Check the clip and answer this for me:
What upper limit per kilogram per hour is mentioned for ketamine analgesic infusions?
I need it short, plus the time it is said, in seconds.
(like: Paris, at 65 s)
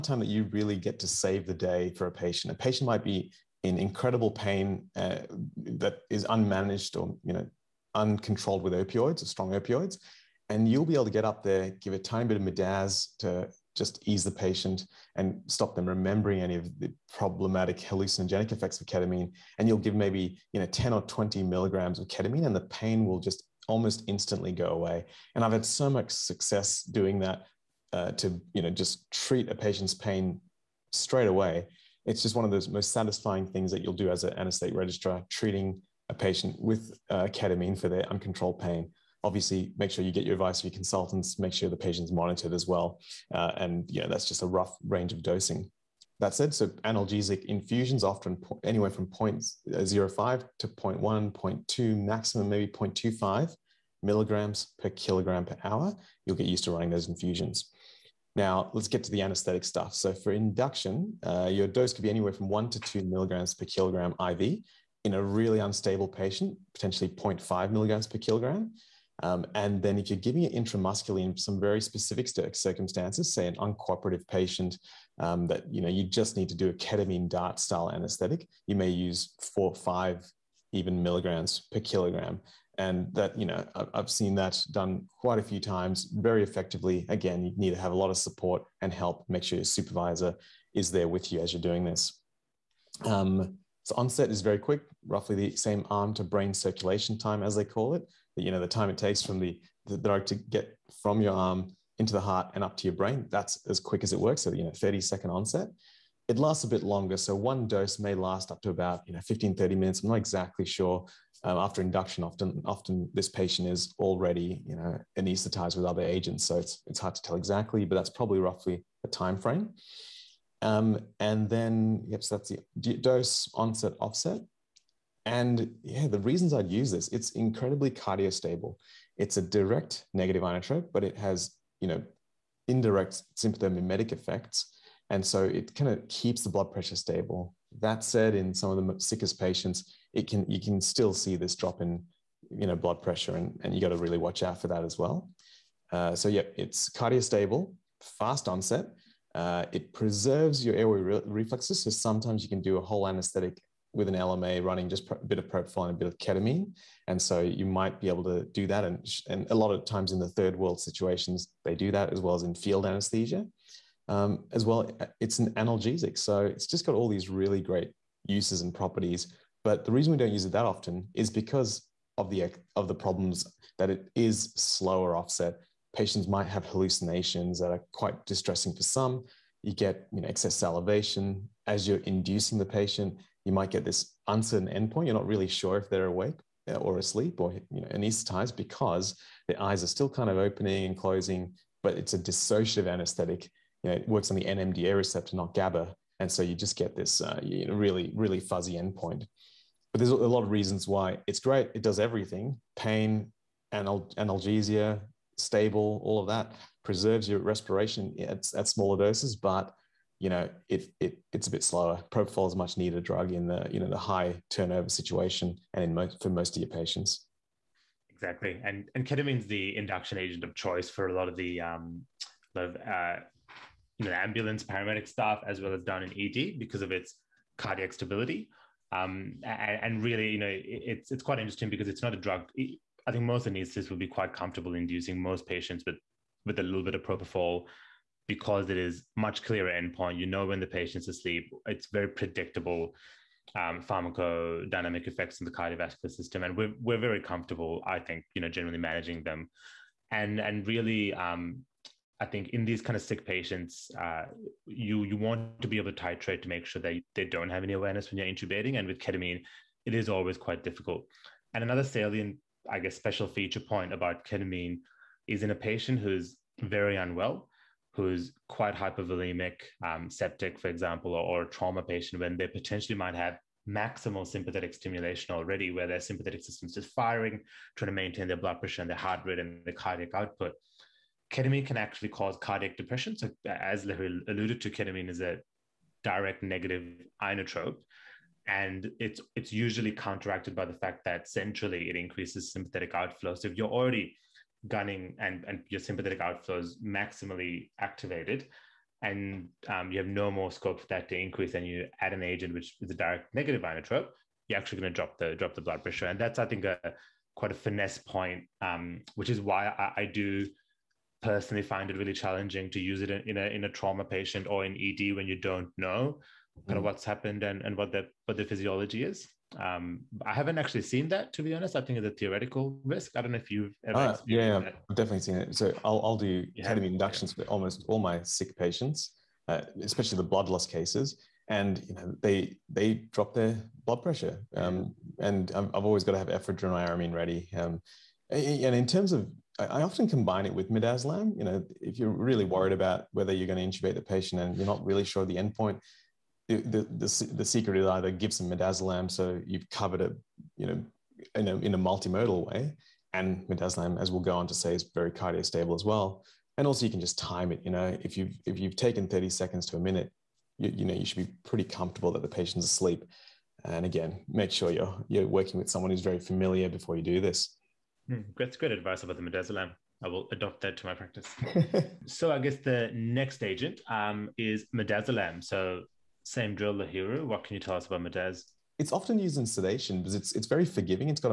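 0.25 milligrams, at 52 s.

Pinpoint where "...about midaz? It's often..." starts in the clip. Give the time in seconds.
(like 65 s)
377 s.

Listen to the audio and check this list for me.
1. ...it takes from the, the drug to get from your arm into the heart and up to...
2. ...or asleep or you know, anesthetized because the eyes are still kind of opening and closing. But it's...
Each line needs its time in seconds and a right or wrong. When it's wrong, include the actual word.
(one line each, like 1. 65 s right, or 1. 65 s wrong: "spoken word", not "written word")
1. 98 s right
2. 186 s right.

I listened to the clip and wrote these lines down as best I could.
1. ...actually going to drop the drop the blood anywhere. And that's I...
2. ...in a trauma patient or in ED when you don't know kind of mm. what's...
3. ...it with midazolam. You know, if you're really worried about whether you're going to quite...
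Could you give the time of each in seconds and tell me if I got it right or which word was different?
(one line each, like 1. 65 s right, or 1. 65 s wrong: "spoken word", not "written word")
1. 304 s wrong: "pressure", not "anywhere"
2. 313 s right
3. 340 s wrong: "intubate", not "quite".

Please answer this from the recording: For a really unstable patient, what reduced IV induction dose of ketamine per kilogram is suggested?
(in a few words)
0.5 milligrams per kilogram.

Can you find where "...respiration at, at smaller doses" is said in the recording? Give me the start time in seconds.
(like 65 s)
207 s.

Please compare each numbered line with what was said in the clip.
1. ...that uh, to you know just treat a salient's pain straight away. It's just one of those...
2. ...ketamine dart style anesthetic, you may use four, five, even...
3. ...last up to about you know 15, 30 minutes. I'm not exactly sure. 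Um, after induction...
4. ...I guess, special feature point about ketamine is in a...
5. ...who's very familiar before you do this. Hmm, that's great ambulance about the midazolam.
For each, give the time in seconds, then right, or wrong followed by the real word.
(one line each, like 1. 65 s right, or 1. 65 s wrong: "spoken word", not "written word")
1. 27 s wrong: "patient", not "salient"
2. 76 s right
3. 108 s right
4. 262 s right
5. 365 s wrong: "advice", not "ambulance".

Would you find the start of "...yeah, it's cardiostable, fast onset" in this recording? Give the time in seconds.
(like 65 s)
146 s.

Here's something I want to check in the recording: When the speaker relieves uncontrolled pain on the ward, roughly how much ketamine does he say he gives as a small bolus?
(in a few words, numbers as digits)
10 or 20 milligrams.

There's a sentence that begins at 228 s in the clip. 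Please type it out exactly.
Um, and, and, really, you know, it, it's it's quite interesting because it's not a drug.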